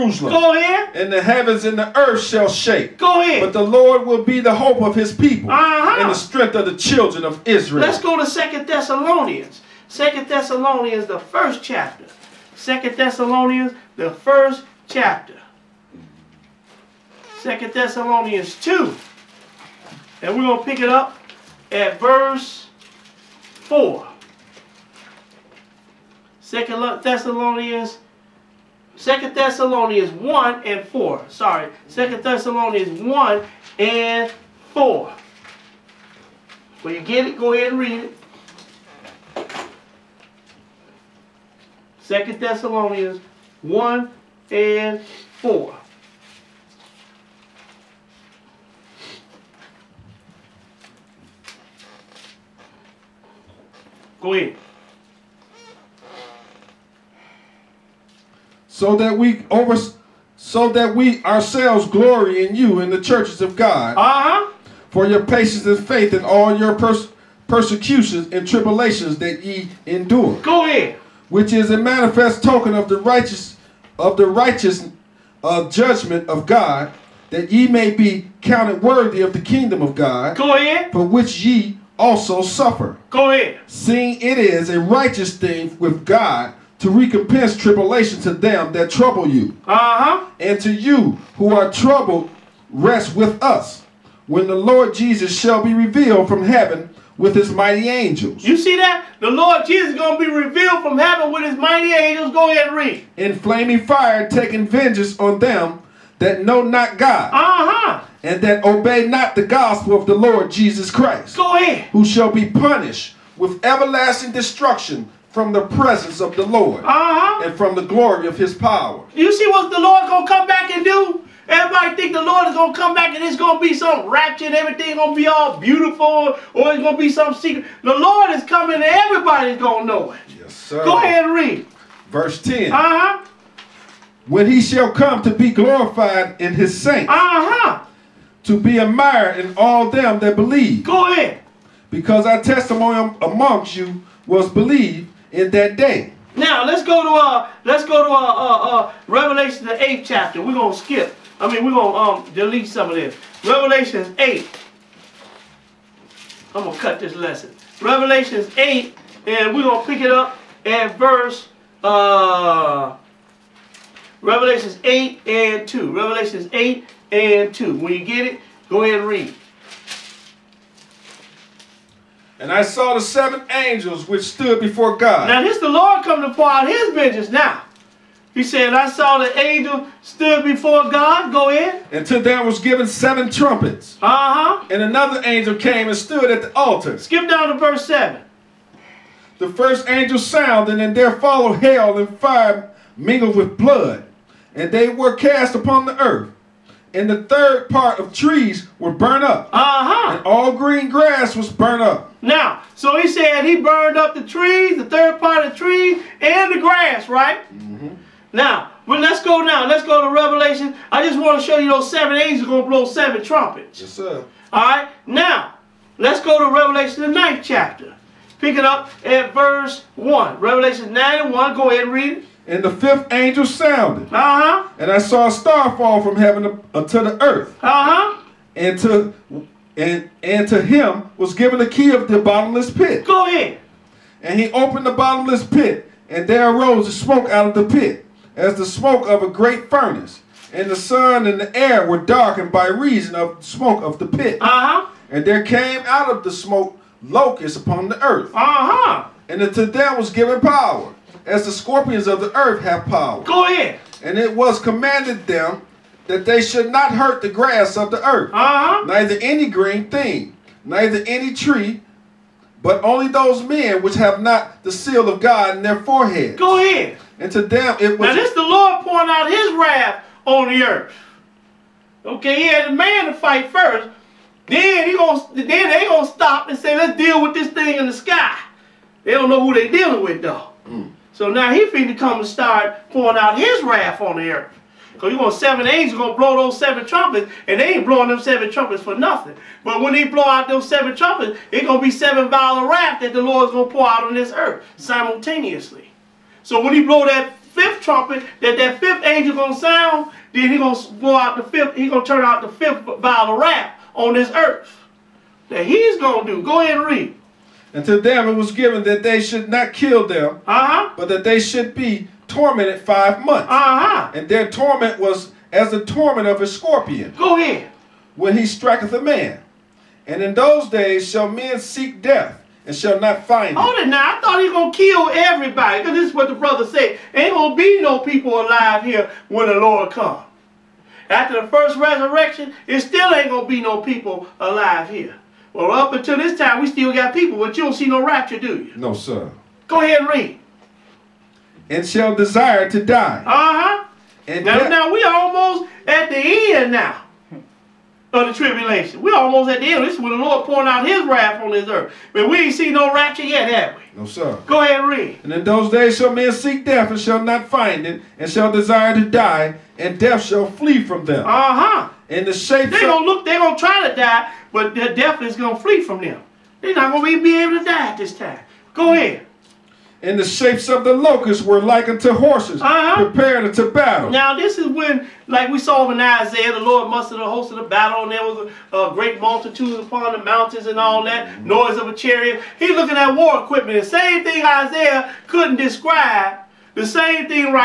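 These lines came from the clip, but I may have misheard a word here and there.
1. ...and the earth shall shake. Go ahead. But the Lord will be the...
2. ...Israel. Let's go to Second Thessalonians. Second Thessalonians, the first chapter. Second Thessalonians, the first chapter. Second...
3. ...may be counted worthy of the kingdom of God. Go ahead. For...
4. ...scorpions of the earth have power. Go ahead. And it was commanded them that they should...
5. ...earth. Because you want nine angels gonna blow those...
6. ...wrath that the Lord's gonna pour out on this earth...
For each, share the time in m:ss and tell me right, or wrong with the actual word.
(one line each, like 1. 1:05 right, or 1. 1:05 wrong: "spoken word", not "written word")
1. 0:01 right
2. 0:07 right
3. 1:17 right
4. 4:11 right
5. 4:44 wrong: "seven", not "nine"
6. 4:52 right.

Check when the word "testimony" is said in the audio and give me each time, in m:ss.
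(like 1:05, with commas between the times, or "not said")
2:22.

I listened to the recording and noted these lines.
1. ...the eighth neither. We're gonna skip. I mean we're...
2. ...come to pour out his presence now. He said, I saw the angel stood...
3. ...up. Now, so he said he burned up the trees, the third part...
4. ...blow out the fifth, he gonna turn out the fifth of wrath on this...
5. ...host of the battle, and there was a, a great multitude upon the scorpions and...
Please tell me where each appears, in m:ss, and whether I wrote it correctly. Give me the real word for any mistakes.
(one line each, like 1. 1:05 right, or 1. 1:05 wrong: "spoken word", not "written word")
1. 2:29 wrong: "chapter", not "neither"
2. 2:56 wrong: "vengeance", not "presence"
3. 3:21 right
4. 5:00 right
5. 6:17 wrong: "mountains", not "scorpions".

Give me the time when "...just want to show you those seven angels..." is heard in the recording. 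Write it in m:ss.
3:31.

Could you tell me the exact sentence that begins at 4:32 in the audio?
Okay, he had a man to fight first.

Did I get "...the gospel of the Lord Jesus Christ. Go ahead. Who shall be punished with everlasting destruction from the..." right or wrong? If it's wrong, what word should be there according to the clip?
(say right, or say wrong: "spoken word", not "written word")
right.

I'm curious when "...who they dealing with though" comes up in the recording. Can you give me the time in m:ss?
4:39.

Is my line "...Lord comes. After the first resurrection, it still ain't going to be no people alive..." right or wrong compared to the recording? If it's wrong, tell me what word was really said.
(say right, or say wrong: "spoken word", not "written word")
right.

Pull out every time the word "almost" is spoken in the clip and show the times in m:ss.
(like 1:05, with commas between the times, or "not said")
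5:45, 5:49.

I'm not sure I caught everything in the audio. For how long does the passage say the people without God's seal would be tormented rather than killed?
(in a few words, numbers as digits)
5 months.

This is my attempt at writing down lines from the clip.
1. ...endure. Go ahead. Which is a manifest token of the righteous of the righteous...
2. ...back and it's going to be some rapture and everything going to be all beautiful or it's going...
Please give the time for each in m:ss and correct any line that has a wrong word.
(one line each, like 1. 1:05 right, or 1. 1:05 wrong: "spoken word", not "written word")
1. 1:09 right
2. 2:02 right.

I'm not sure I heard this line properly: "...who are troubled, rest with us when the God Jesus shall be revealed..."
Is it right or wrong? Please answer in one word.
wrong.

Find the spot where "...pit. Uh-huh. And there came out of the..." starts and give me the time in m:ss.
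4:04.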